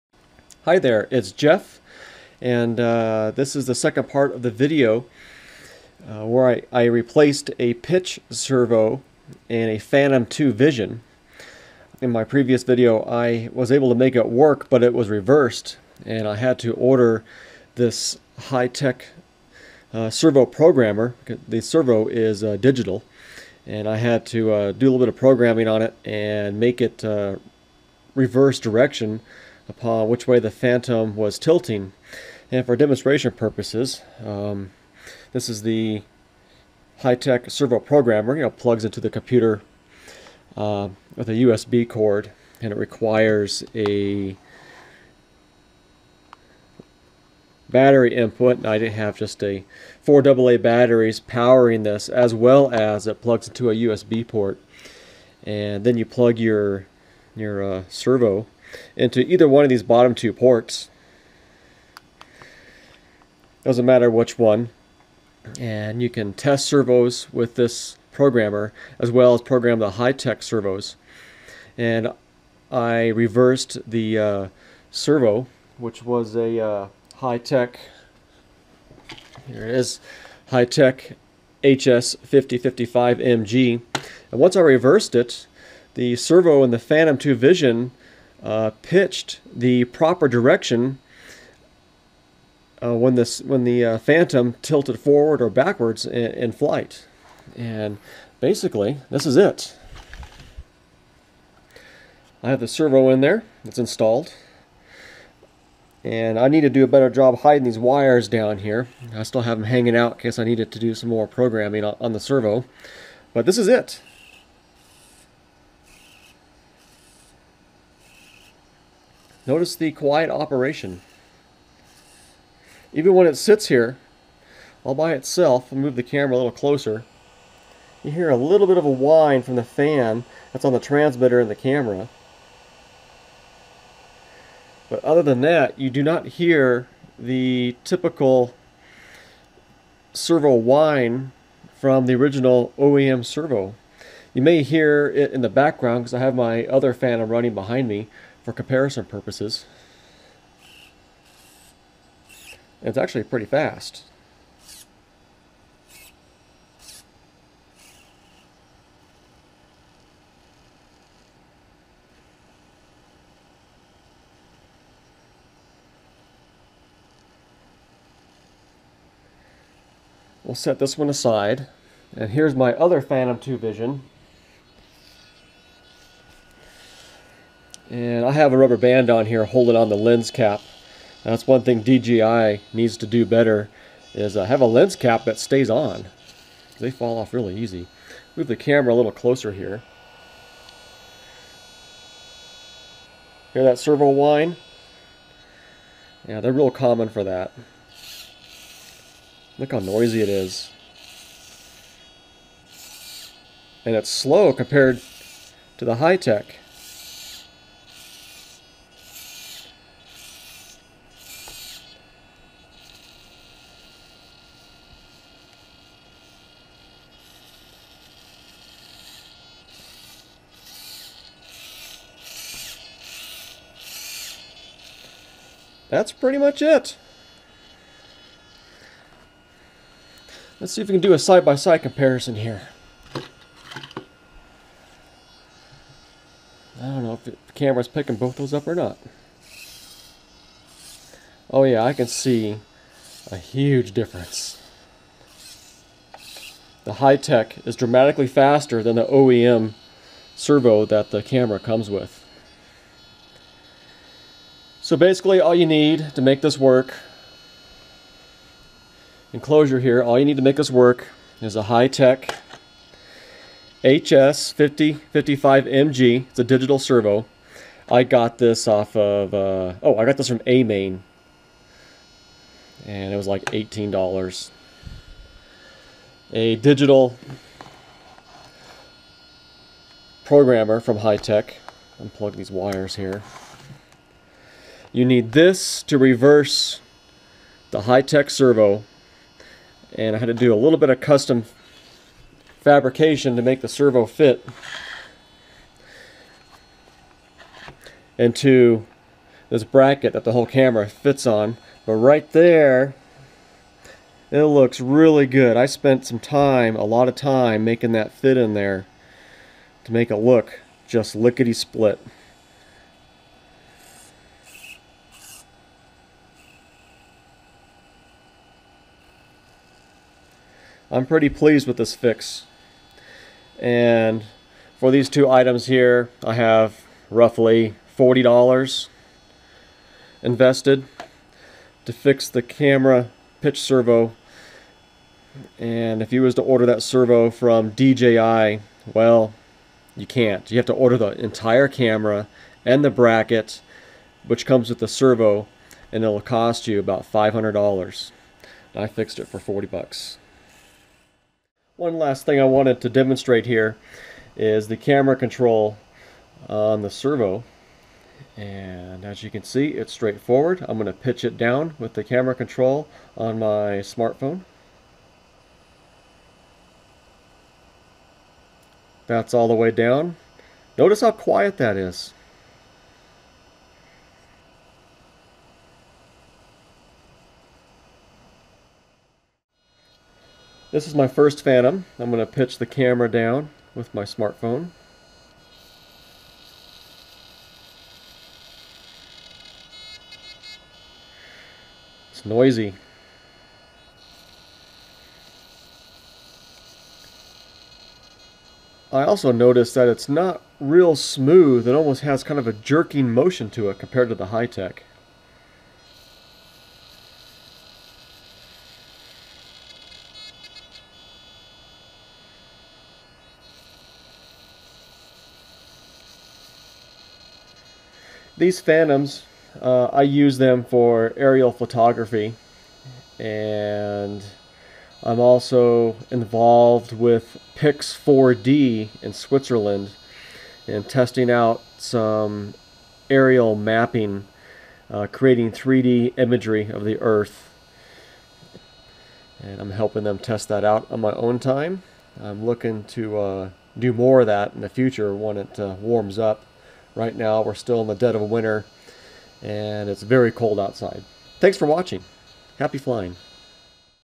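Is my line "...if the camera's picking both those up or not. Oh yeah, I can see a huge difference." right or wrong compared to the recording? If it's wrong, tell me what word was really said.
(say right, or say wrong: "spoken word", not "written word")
right.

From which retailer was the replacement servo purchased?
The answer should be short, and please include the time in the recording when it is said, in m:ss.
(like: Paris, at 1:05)
AMain, at 4:30.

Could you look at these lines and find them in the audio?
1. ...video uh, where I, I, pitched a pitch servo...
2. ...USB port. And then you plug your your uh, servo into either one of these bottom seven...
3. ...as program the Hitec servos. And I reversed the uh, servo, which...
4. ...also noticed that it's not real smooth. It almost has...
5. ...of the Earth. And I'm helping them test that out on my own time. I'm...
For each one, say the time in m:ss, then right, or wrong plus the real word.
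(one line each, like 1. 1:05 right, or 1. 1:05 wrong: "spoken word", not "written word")
1. 0:04 wrong: "replaced", not "pitched"
2. 0:53 wrong: "two", not "seven"
3. 1:09 right
4. 6:39 right
5. 7:16 right.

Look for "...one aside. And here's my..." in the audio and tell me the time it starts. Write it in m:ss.
2:50.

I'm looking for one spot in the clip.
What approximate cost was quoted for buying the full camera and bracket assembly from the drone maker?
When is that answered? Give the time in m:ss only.
5:47.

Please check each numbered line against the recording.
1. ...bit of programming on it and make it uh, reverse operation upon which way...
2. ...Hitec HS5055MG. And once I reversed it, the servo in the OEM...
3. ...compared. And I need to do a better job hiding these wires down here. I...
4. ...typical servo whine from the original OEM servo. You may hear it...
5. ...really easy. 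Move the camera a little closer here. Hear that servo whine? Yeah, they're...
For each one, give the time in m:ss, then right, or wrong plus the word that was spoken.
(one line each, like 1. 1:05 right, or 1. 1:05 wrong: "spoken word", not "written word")
1. 0:24 wrong: "direction", not "operation"
2. 1:20 wrong: "Phantom", not "OEM"
3. 1:43 wrong: "installed", not "compared"
4. 2:17 right
5. 3:07 right.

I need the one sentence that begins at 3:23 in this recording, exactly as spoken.
And it's slow compared to the Hitec.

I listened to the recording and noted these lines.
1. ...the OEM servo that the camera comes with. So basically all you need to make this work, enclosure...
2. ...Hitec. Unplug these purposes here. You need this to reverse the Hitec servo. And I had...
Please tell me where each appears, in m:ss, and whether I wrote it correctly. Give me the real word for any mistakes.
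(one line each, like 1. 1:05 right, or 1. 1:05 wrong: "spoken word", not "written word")
1. 4:08 right
2. 4:40 wrong: "wires", not "purposes".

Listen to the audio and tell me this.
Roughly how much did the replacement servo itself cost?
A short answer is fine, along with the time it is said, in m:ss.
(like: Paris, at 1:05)
$18, at 4:33.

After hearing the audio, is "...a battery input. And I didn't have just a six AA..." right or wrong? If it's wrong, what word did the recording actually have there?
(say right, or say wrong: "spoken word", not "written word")
wrong: "four", not "six".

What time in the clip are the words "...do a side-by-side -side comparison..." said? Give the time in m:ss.
3:51.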